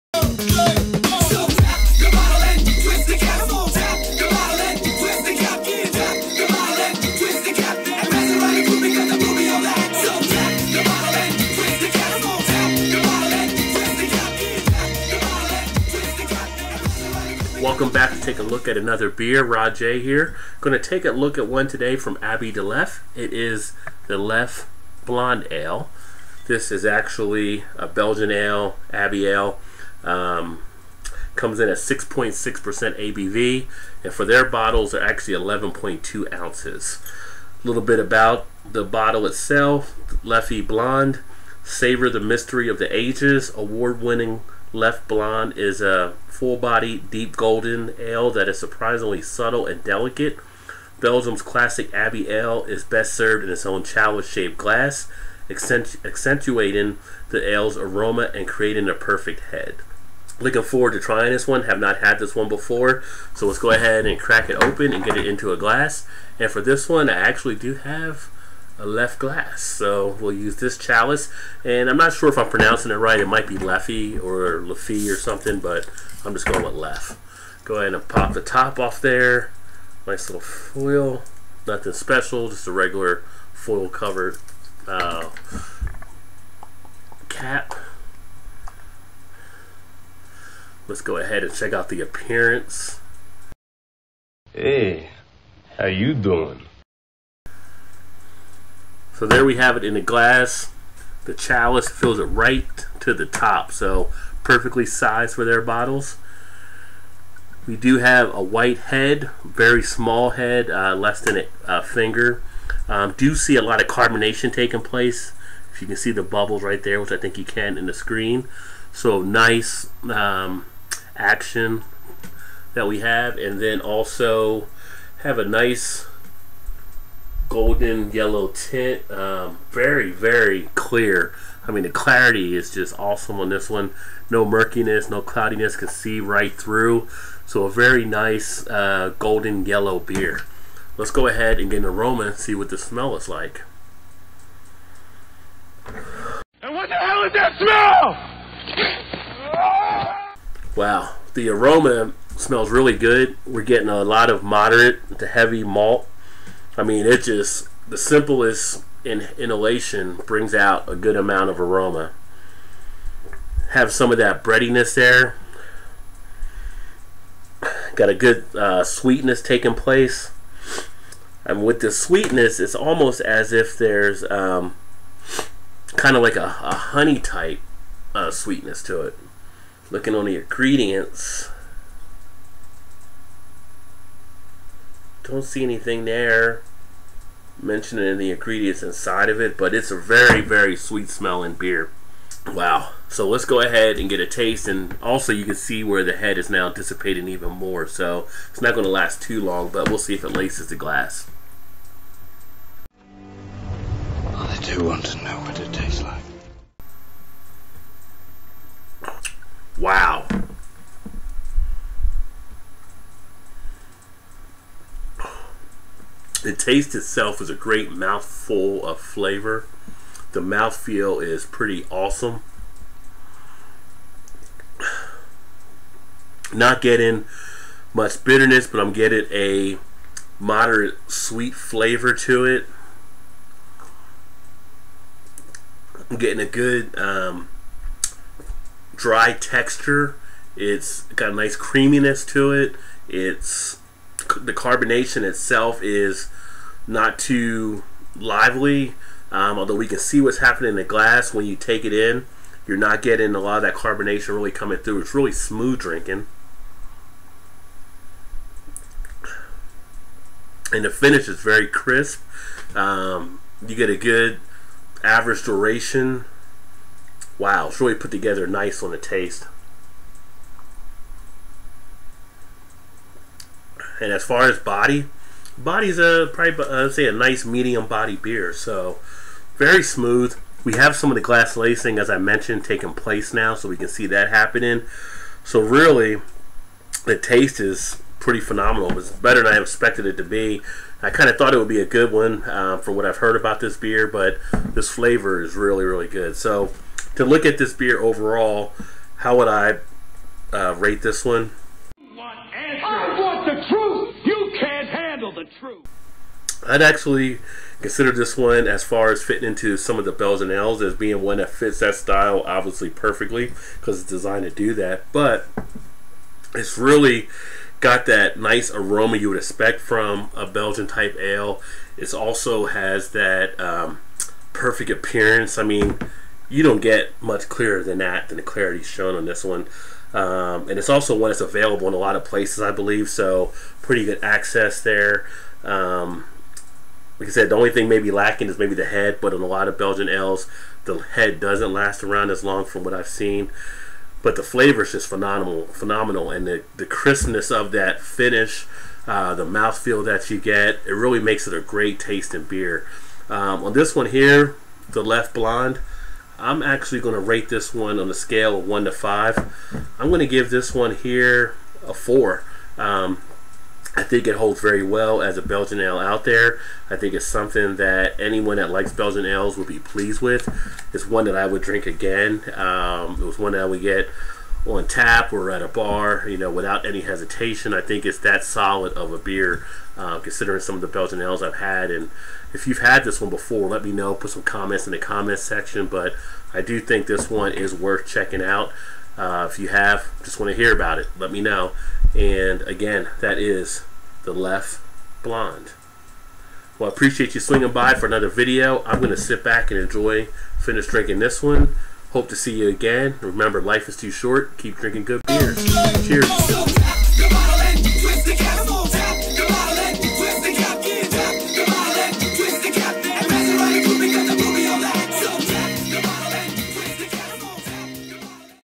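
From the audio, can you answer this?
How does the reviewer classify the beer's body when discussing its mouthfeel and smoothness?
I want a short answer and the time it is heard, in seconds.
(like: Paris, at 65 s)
medium body, at 277 s.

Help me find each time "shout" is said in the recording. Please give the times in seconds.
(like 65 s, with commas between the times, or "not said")
not said.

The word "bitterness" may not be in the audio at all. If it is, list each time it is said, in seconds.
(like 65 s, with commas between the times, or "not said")
228 s.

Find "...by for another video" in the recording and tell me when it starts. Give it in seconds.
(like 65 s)
397 s.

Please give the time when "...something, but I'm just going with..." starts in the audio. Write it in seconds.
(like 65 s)
75 s.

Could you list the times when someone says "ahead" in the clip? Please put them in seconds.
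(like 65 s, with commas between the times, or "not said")
63 s, 77 s, 91 s, 141 s, 193 s.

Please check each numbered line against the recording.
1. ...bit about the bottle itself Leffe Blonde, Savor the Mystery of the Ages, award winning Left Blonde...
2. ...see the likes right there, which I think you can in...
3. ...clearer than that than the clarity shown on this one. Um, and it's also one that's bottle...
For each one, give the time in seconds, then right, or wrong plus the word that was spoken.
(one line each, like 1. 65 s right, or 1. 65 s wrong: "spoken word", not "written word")
1. 37 s right
2. 115 s wrong: "bubbles", not "likes"
3. 327 s wrong: "available", not "bottle".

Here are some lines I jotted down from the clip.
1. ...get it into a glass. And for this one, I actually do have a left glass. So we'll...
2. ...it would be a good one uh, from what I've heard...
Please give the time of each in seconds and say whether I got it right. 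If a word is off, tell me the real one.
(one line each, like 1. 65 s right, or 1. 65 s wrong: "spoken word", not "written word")
1. 65 s right
2. 291 s right.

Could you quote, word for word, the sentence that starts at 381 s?
And if you've had this one before, let me know.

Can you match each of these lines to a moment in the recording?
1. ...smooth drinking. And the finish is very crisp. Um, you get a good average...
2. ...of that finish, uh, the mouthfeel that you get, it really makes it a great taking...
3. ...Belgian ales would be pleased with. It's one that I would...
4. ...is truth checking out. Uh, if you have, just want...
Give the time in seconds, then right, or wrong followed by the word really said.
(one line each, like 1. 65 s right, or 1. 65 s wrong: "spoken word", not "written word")
1. 255 s right
2. 347 s wrong: "tasting", not "taking"
3. 368 s right
4. 387 s wrong: "worth", not "truth".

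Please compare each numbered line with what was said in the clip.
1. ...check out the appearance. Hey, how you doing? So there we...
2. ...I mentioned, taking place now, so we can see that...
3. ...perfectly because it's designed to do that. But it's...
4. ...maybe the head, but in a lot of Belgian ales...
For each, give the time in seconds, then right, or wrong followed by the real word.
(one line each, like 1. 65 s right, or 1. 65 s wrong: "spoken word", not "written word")
1. 91 s right
2. 282 s right
3. 312 s right
4. 338 s right.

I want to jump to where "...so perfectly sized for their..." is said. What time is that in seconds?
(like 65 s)
103 s.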